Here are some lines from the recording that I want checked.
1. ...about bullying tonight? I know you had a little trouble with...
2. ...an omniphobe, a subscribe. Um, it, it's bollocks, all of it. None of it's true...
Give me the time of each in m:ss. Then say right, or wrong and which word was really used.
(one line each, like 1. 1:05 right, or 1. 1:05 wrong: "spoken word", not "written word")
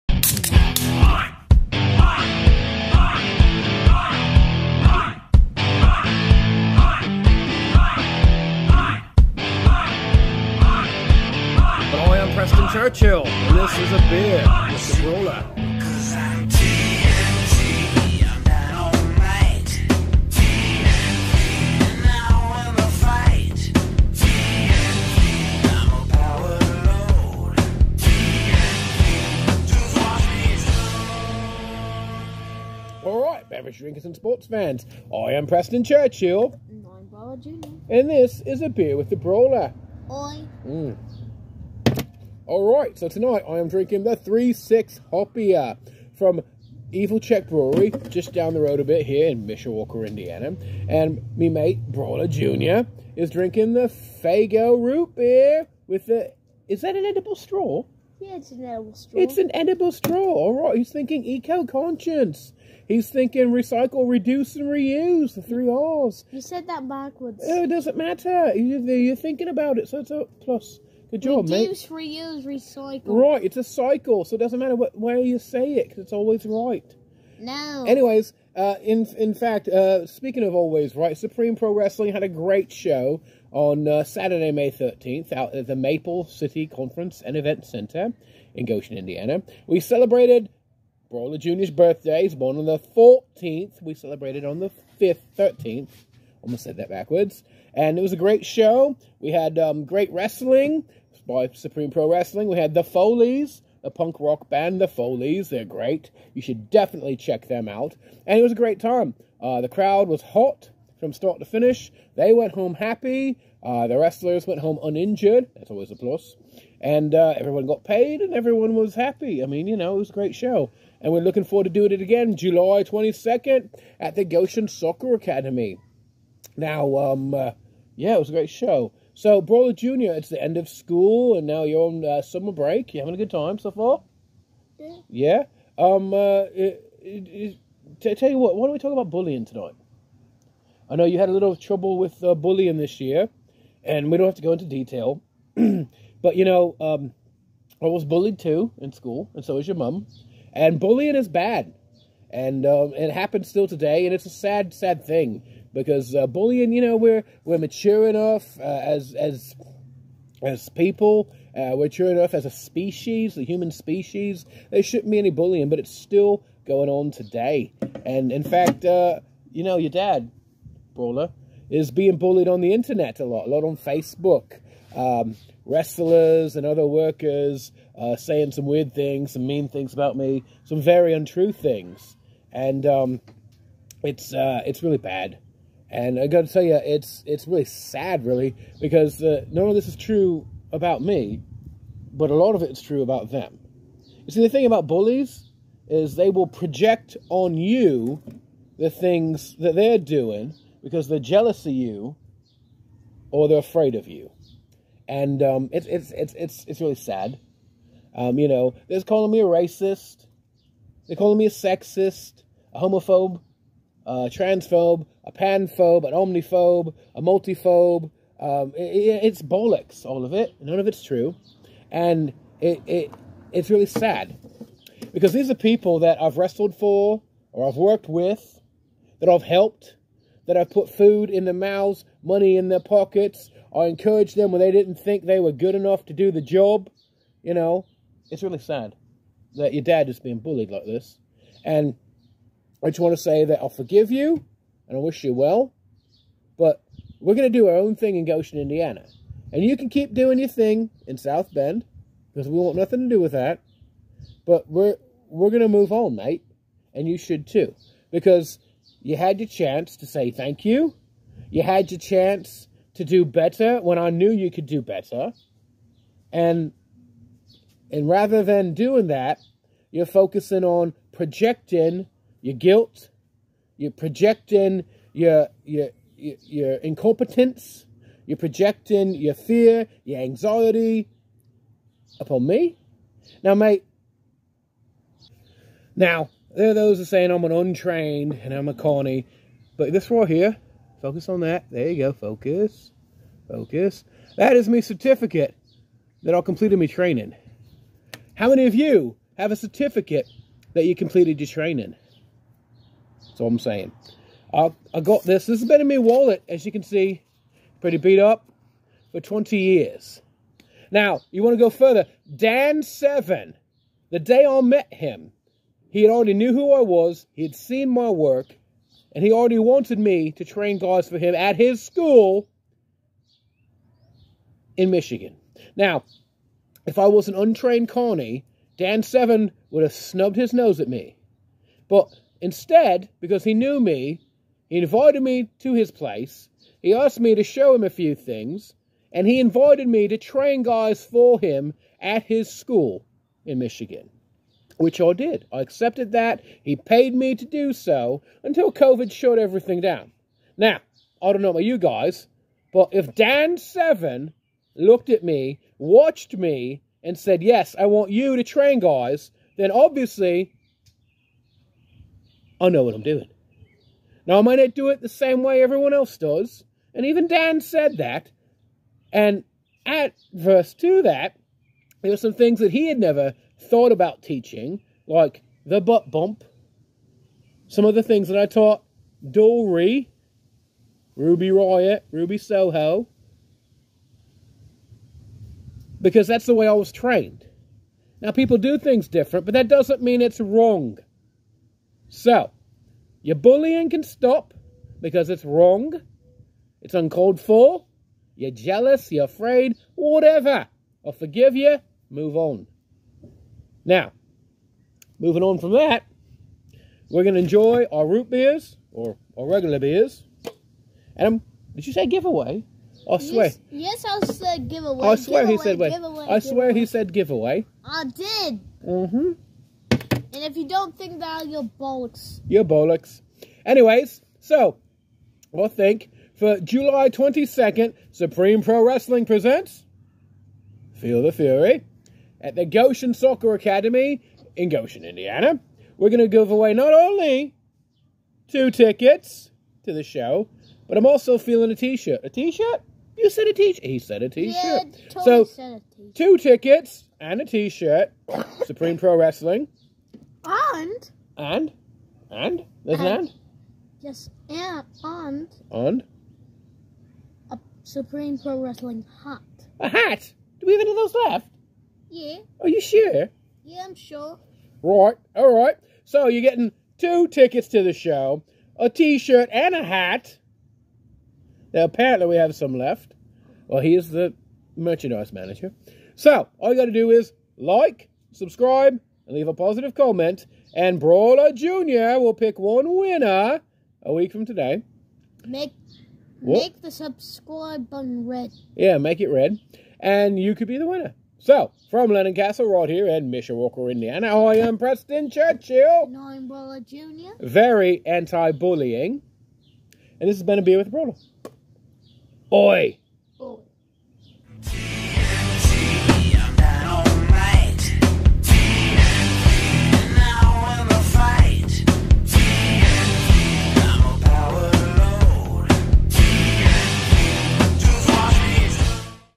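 1. 2:18 right
2. 3:36 wrong: "multiphobe", not "subscribe".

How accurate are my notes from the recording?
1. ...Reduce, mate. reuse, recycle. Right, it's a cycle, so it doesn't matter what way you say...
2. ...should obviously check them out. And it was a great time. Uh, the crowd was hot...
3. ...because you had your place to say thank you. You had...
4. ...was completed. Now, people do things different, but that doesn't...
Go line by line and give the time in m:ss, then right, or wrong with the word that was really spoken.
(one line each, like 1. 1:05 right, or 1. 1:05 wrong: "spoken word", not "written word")
1. 1:11 right
2. 1:46 wrong: "definitely", not "obviously"
3. 4:18 wrong: "chance", not "place"
4. 6:26 wrong: "trained", not "completed".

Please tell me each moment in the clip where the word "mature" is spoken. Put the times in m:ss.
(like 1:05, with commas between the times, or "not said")
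2:37, 2:41.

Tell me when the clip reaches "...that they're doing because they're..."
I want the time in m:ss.
3:19.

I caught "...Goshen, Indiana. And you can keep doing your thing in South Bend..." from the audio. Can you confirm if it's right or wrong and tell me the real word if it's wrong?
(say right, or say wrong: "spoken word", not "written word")
right.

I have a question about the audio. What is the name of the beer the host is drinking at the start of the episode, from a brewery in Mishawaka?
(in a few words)
3-6 Hoppier.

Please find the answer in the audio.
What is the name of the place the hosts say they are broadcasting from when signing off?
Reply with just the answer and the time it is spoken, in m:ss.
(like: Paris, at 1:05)
Lennon Castle, at 8:12.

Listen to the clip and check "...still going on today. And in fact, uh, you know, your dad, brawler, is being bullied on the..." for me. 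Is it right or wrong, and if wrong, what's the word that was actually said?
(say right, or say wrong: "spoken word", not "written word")
right.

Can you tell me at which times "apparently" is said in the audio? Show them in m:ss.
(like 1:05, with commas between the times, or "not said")
7:51.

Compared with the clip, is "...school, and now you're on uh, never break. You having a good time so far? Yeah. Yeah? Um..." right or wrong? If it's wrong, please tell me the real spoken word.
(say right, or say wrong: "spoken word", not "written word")
wrong: "summer", not "never".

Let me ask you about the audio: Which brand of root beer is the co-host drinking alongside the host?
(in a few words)
Faygo.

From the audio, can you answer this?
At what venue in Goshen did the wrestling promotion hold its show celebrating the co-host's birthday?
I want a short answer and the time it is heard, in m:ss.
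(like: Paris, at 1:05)
Maple City Conference and Event Center, at 1:25.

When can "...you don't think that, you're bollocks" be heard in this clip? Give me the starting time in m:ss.
7:00.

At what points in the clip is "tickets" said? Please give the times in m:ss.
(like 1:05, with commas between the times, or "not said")
7:18, 7:26, 7:47.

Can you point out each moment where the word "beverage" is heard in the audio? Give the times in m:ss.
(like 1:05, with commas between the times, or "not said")
0:33.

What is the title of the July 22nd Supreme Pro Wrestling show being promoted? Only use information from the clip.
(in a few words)
Feel the Fury.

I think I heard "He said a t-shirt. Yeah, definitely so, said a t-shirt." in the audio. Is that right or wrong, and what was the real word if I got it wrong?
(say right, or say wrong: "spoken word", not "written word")
wrong: "totally", not "definitely".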